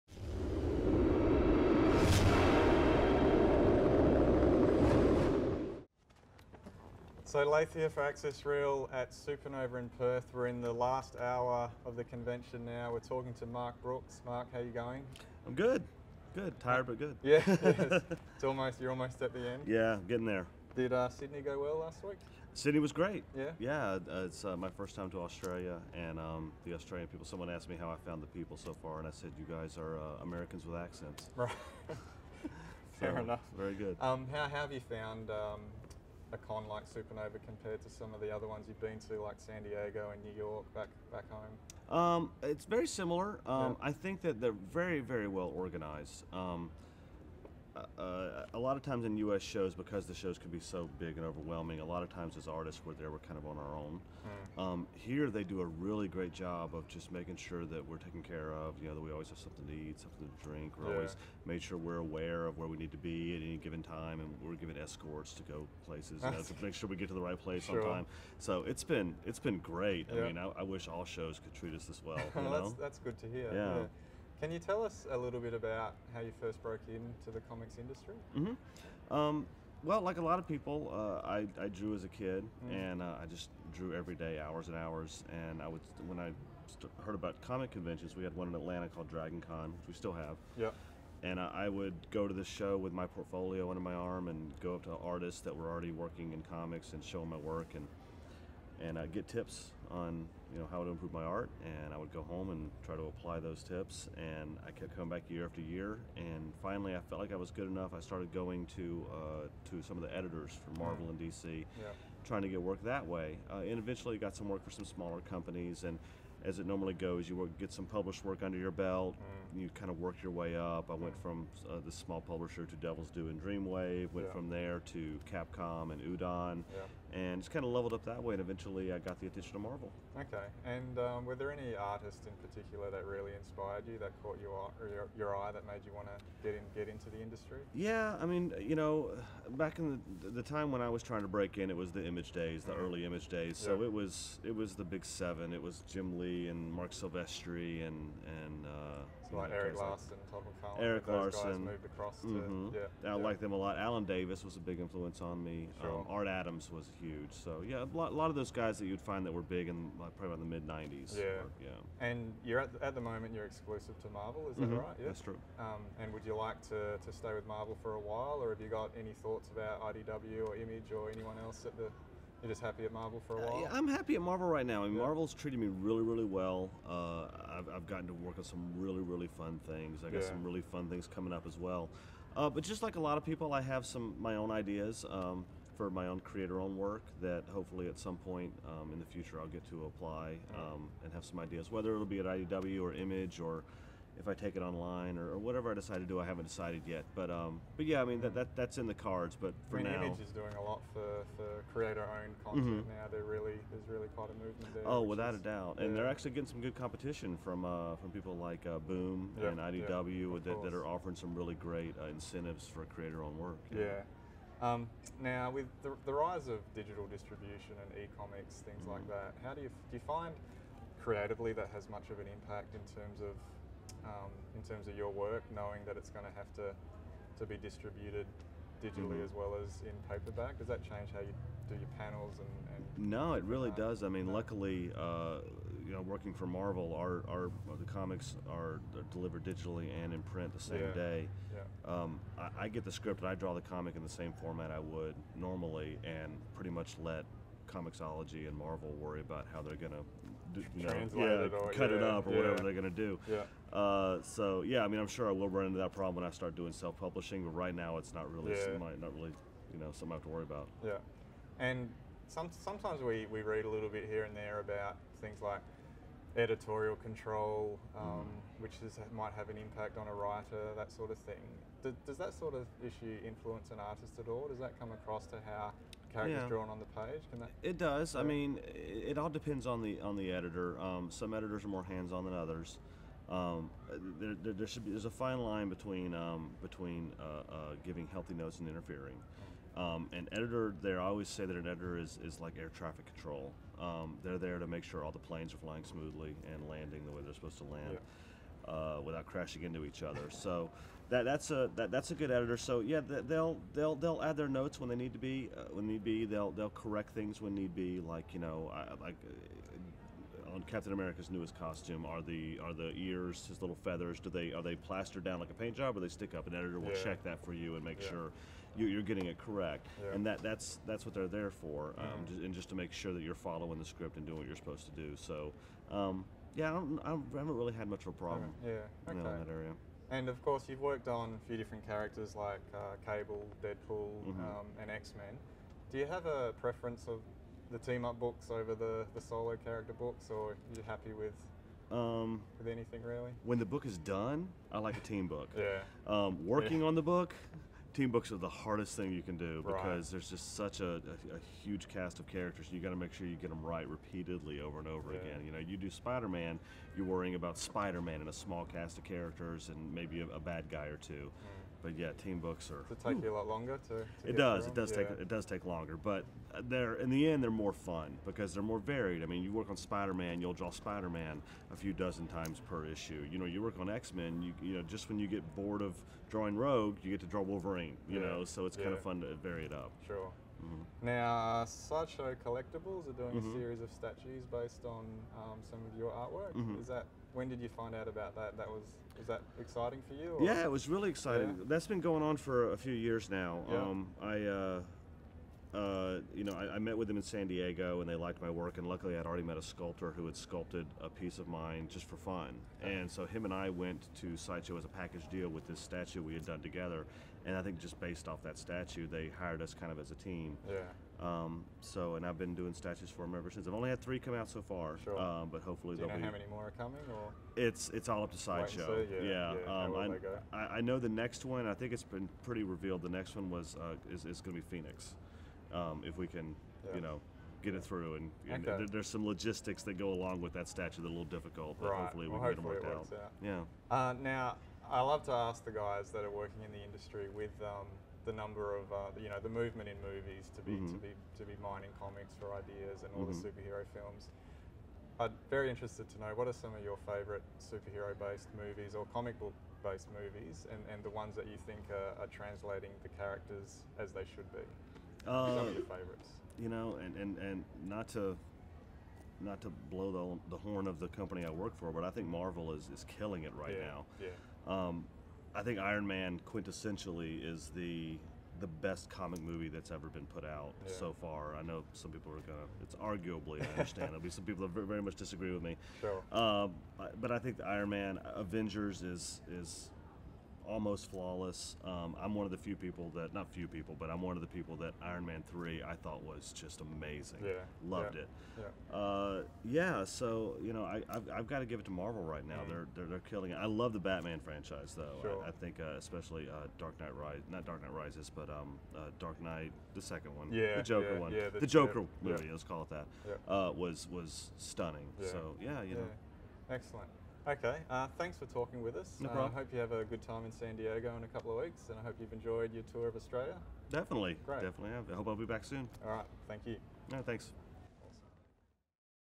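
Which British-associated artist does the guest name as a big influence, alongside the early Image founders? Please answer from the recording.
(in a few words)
Alan Davis.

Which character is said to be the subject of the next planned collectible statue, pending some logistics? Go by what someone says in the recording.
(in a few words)
Phoenix.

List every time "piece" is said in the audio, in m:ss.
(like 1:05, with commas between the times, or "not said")
6:41.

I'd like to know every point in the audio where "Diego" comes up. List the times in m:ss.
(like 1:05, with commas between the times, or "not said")
0:39, 6:37, 8:30.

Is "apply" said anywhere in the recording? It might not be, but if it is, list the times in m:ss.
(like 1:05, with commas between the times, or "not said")
1:43, 3:09.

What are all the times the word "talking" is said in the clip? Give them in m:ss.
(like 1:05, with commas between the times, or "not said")
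0:12, 8:28.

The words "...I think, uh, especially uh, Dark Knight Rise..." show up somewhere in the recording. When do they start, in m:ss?
8:15.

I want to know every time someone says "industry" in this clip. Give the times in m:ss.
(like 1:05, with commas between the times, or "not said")
1:17, 2:17, 7:16.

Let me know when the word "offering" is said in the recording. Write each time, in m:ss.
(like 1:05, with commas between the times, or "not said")
3:30.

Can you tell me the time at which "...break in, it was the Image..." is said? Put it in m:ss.
2:21.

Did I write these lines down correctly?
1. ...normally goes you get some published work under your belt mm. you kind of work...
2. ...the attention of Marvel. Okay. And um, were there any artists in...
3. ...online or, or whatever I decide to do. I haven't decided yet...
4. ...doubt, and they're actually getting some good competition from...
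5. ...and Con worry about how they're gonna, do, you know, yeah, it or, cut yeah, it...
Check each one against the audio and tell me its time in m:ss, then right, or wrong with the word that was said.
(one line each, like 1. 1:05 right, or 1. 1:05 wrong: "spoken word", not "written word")
1. 1:56 right
2. 2:09 right
3. 3:14 right
4. 3:25 right
5. 4:08 wrong: "Marvel", not "Con".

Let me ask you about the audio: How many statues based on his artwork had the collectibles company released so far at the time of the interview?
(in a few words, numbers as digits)
3.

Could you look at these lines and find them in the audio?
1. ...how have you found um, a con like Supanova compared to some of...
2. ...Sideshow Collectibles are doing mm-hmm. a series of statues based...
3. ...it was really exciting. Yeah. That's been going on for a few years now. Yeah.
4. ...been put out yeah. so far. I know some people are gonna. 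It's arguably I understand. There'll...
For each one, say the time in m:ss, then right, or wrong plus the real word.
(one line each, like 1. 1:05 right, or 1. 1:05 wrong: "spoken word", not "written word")
1. 0:34 right
2. 6:21 right
3. 6:30 right
4. 7:50 right.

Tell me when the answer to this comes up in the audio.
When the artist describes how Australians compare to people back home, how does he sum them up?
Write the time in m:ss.
0:30.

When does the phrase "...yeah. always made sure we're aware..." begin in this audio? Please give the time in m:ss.
1:00.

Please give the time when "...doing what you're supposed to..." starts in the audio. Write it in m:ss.
5:24.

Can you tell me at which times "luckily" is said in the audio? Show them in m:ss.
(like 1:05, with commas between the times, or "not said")
3:54, 6:38.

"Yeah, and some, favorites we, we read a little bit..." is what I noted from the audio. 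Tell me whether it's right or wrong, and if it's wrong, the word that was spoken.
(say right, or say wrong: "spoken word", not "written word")
wrong: "sometimes", not "favorites".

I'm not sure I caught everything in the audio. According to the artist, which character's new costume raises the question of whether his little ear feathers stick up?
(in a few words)
Captain America.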